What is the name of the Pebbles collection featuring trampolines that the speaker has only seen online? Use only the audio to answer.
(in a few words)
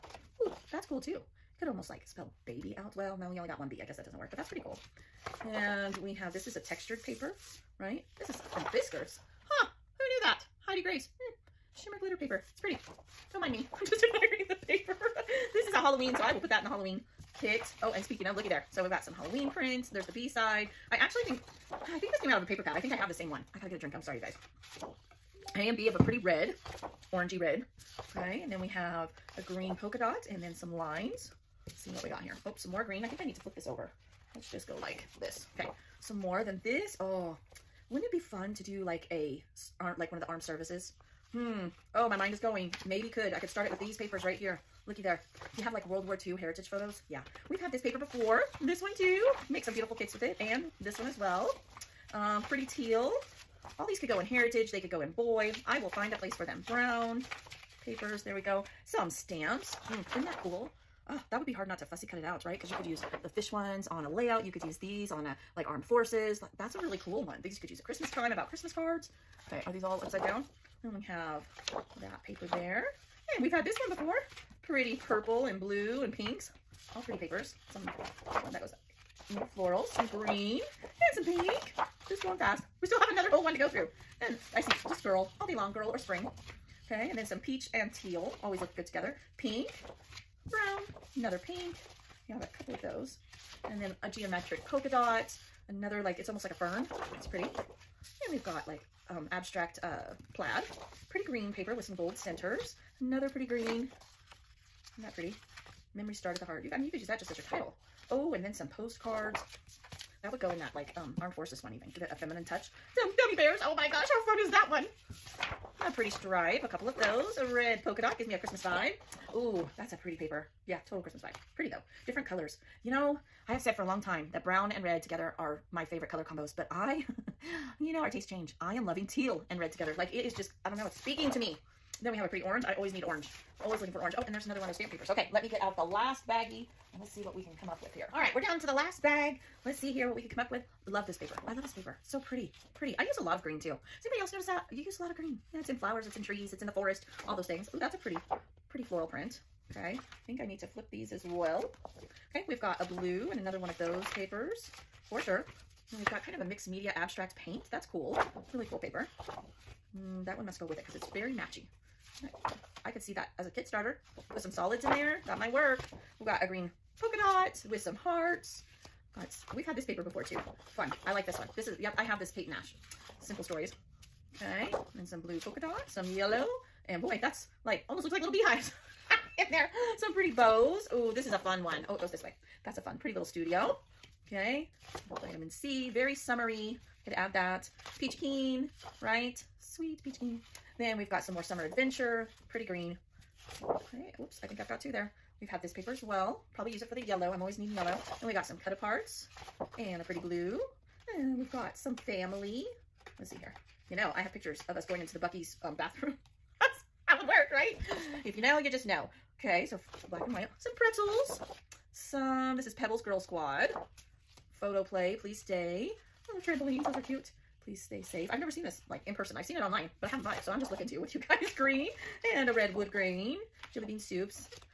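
Girl Squad.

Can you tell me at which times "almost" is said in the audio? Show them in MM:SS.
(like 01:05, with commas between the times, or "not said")
00:01, 01:36, 02:57.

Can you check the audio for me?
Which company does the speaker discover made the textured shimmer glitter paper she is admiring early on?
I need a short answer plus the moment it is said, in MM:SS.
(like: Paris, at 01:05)
Fiskars, at 00:08.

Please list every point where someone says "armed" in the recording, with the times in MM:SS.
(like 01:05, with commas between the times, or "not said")
00:40, 01:05, 01:51.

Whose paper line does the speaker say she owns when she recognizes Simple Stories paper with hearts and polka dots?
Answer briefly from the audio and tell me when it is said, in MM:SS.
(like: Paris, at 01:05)
Kate Nash, at 02:52.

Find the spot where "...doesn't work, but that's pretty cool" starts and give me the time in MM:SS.
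00:04.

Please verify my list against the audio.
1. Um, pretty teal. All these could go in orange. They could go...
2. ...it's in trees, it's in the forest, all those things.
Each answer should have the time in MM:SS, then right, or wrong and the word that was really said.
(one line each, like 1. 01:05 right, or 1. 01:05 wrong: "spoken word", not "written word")
1. 00:52 wrong: "heritage", not "orange"
2. 02:26 right.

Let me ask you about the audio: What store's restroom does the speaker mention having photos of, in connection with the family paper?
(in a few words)
Buc-ee's.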